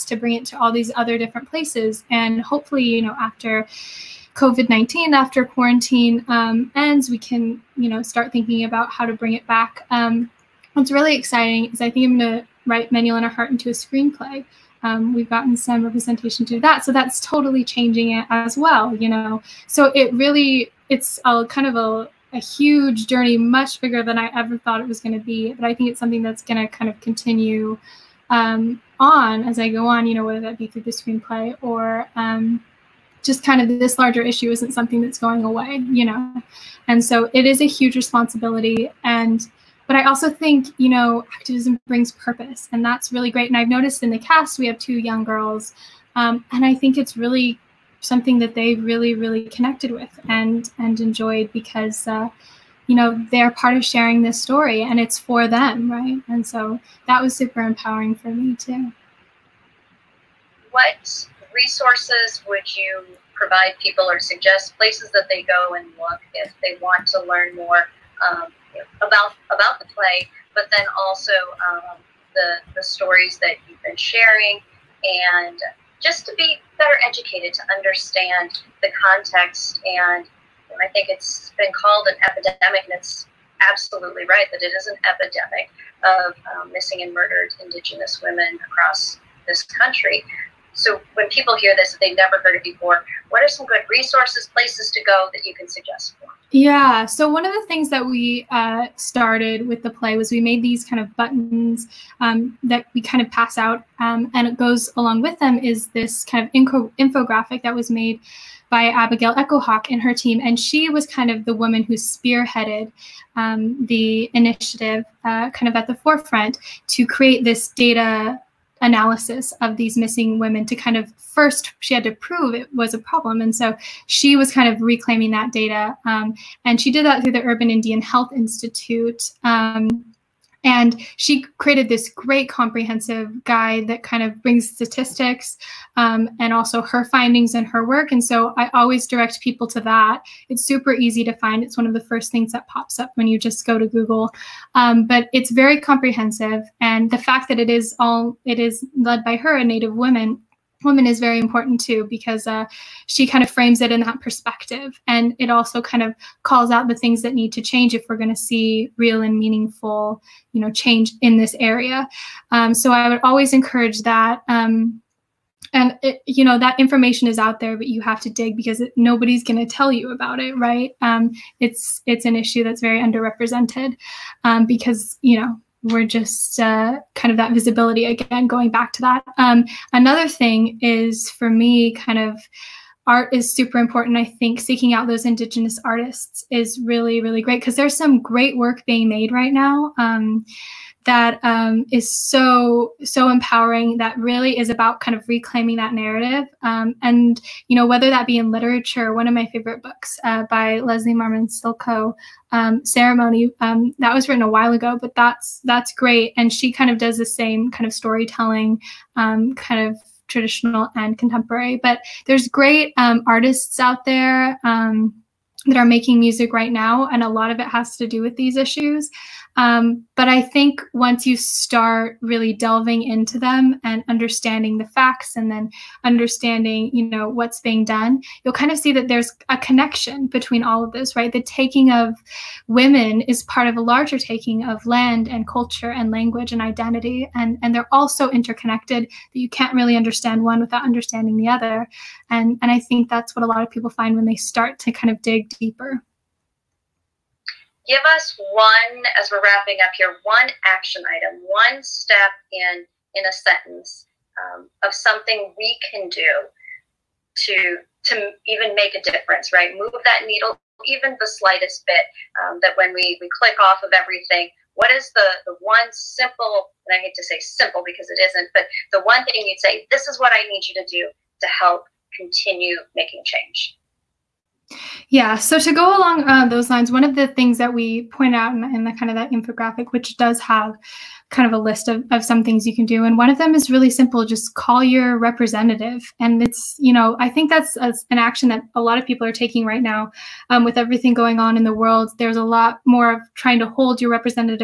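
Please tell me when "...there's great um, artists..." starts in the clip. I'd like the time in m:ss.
3:32.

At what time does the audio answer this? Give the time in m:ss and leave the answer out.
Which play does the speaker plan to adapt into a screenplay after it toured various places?
0:12.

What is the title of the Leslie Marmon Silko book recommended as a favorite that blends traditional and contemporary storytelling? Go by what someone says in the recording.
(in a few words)
Ceremony.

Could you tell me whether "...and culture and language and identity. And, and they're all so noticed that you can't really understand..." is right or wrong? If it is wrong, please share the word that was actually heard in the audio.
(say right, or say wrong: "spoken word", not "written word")
wrong: "interconnected", not "noticed".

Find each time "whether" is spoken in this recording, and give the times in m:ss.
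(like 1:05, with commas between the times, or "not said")
0:30, 3:17.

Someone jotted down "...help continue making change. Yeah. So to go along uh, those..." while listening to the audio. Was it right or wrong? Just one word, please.
right.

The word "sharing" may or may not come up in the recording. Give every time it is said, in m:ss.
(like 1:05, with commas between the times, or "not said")
0:53, 1:13.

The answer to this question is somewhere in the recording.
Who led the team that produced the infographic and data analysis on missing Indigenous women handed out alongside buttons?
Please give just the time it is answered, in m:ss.
1:48.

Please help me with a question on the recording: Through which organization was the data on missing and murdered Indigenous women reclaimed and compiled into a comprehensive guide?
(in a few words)
Urban Indian Health Institute.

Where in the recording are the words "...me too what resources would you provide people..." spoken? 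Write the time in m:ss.
0:58.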